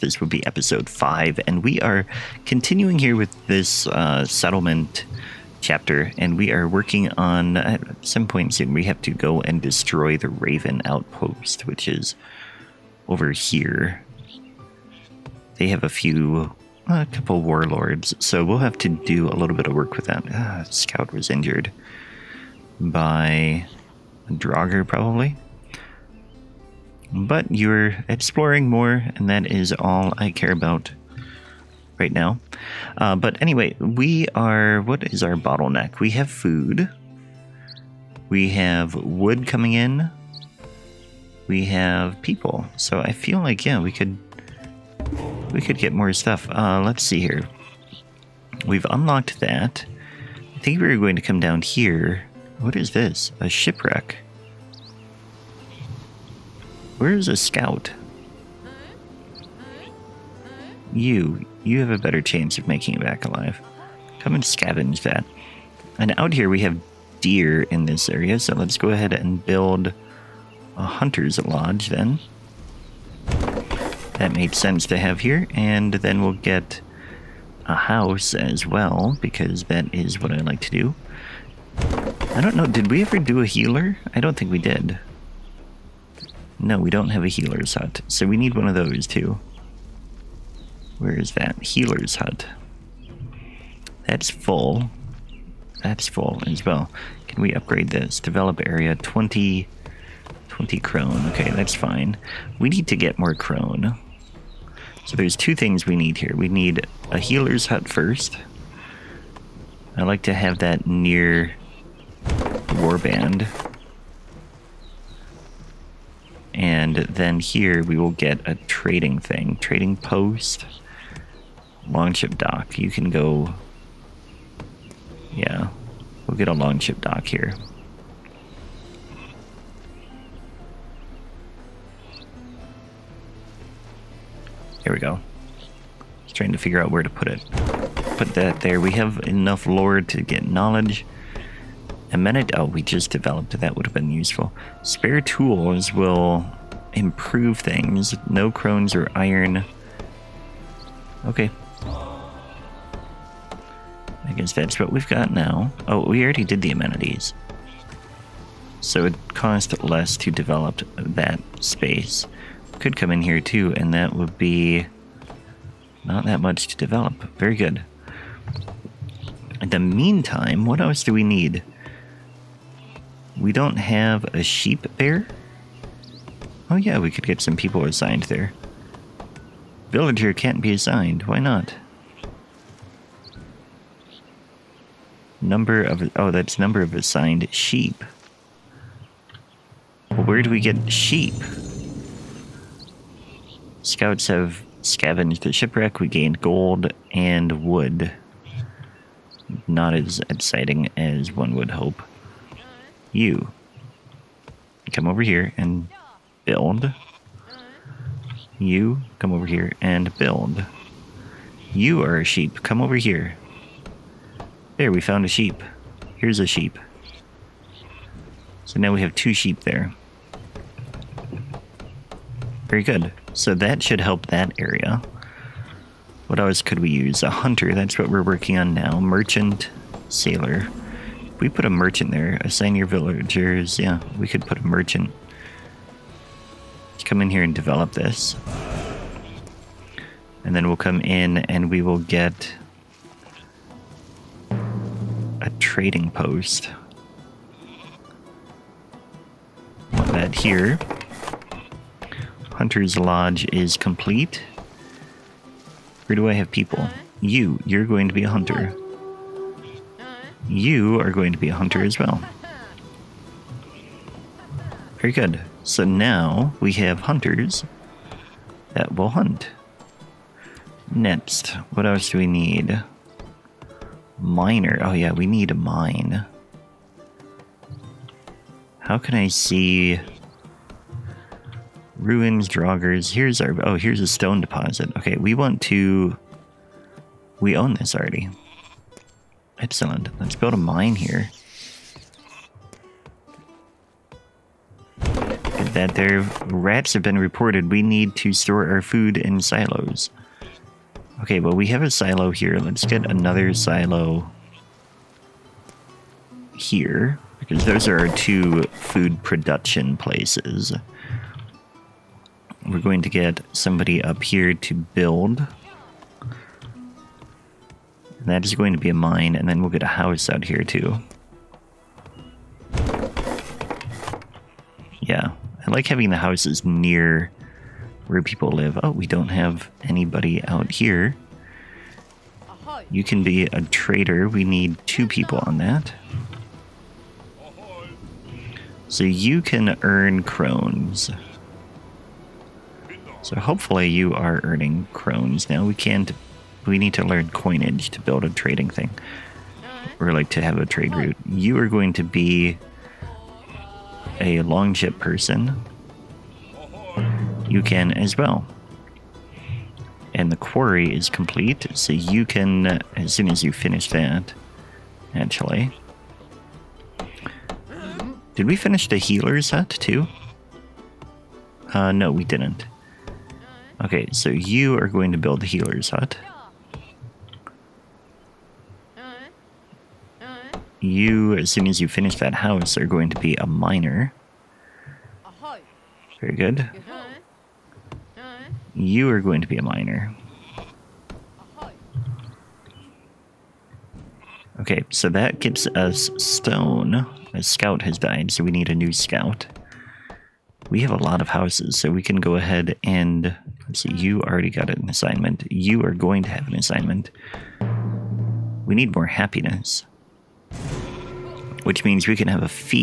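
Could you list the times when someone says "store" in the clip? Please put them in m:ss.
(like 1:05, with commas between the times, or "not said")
4:58.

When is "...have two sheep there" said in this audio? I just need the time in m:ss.
3:39.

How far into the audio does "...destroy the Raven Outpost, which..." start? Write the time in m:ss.
0:09.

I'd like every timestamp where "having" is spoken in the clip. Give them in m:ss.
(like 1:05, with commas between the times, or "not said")
5:25.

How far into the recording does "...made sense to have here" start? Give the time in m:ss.
1:14.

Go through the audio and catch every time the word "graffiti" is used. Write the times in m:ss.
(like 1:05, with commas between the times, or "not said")
not said.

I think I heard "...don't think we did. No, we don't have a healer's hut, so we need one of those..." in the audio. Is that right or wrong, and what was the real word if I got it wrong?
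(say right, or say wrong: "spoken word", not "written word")
right.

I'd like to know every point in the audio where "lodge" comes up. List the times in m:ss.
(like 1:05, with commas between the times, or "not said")
1:11, 4:12.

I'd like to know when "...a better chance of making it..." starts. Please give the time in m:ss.
1:01.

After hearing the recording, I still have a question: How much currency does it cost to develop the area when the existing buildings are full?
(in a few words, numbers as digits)
20 crone.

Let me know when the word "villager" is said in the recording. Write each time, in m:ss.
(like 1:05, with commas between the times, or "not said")
2:59, 3:52.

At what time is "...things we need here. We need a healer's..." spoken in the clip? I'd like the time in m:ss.
1:45.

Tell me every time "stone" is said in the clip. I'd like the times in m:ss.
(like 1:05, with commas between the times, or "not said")
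4:44, 6:36.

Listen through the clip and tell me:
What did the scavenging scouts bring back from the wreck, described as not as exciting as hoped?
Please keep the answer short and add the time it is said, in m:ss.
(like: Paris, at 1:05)
Gold and wood, at 3:16.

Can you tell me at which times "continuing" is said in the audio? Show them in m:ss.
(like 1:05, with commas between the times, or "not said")
0:02.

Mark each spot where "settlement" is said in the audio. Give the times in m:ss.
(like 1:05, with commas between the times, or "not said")
0:04.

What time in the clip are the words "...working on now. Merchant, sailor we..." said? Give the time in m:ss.
3:48.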